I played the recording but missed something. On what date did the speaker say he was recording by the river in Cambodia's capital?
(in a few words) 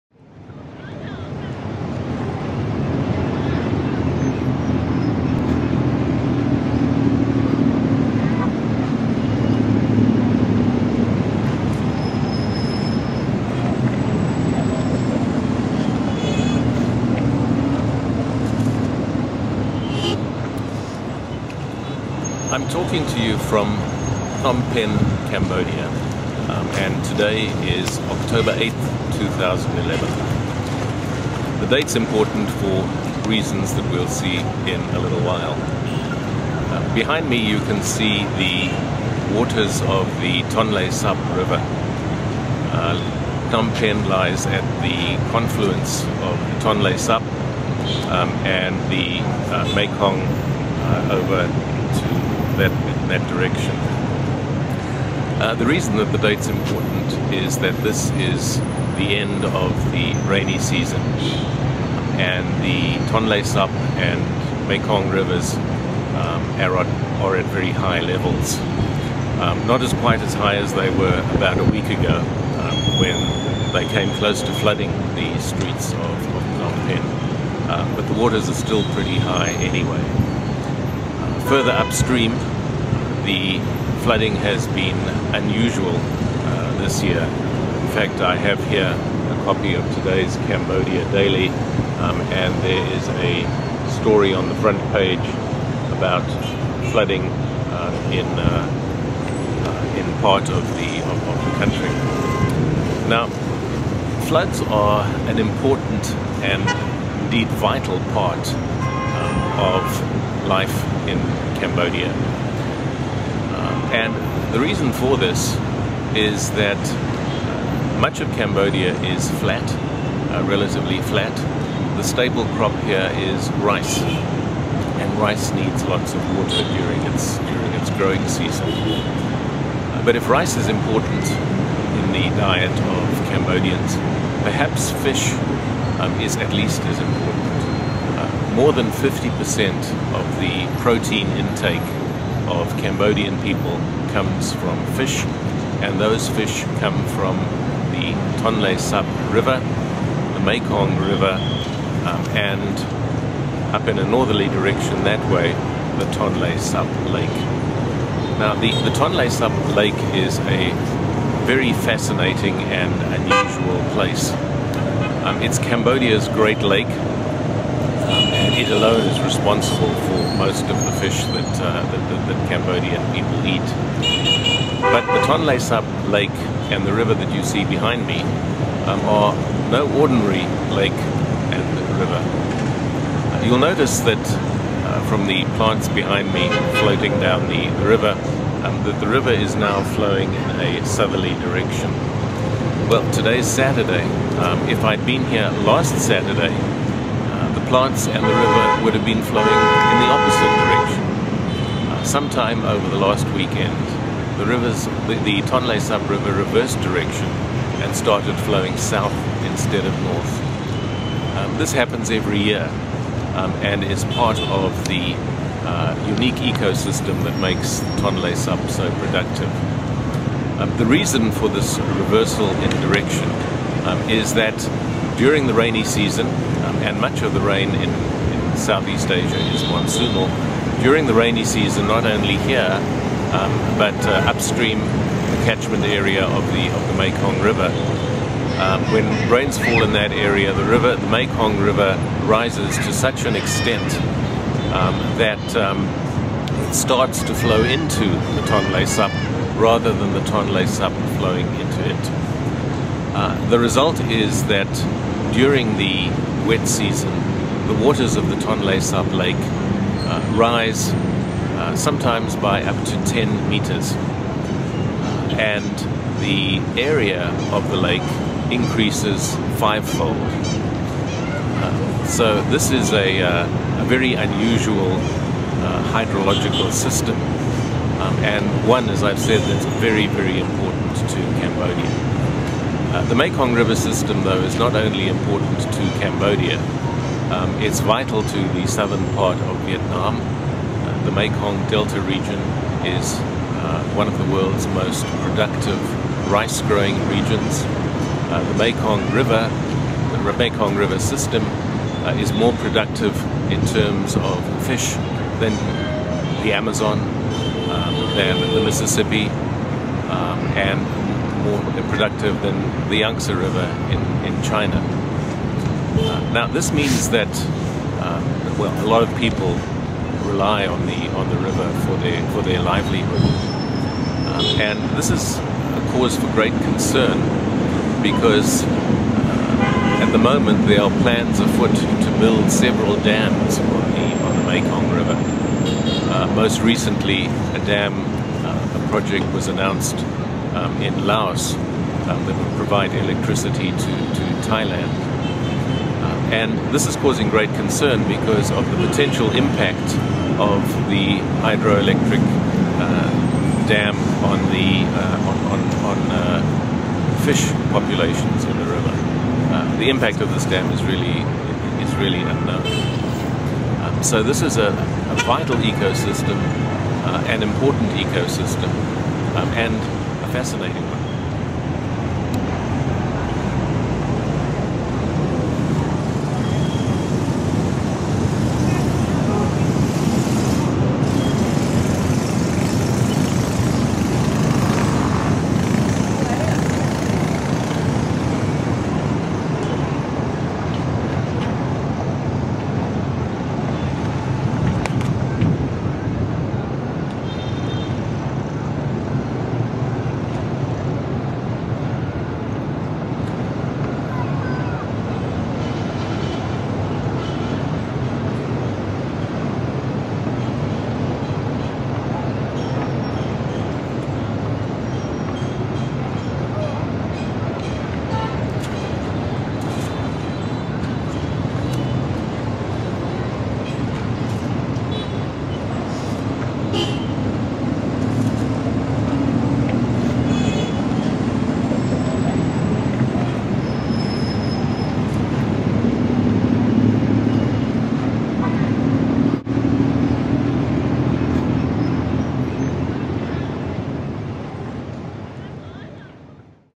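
October 8th, 2011.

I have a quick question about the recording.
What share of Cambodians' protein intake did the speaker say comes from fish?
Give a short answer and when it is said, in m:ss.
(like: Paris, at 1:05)
More than 50%, at 2:18.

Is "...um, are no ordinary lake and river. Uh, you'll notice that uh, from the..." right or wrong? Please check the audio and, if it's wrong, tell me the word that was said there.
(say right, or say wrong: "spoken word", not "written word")
right.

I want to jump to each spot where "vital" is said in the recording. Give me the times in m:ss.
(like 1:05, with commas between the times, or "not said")
1:47, 4:47, 6:05.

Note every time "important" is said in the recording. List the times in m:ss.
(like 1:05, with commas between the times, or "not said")
0:31, 0:56, 1:45, 2:10, 2:16, 4:40, 4:45, 6:07.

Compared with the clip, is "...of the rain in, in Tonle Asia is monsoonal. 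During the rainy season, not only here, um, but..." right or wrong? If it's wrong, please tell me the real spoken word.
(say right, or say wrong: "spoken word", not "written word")
wrong: "Southeast", not "Tonle".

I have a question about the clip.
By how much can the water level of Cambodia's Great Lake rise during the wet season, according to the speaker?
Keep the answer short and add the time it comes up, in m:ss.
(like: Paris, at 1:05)
Up to 10 meters, at 4:22.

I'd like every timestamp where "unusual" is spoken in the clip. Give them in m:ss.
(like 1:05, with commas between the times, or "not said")
1:25, 2:43, 4:34.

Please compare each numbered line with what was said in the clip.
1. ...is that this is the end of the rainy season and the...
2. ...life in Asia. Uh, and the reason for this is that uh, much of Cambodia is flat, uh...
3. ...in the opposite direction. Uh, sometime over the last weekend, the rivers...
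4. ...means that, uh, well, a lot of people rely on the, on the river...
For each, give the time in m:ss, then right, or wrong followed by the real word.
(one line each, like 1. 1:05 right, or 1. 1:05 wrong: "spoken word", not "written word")
1. 0:57 right
2. 1:50 wrong: "Cambodia", not "Asia"
3. 3:19 right
4. 5:16 right.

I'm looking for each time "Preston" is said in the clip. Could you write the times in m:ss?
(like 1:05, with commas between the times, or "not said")
not said.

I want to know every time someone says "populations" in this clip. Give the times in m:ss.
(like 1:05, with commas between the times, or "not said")
5:57.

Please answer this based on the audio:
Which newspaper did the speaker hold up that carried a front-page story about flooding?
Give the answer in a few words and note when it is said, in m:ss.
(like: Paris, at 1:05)
Cambodia Daily, at 1:30.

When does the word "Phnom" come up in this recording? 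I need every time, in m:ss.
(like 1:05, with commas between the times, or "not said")
0:24, 0:43, 1:16.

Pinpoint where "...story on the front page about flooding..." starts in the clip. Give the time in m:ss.
1:34.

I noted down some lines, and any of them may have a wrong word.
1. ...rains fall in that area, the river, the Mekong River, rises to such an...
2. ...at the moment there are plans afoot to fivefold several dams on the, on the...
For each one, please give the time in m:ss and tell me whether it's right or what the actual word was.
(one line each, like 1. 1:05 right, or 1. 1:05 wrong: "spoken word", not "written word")
1. 3:59 right
2. 5:30 wrong: "build", not "fivefold".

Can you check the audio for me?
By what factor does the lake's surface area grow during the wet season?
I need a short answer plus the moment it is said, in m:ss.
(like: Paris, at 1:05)
Fivefold, at 4:29.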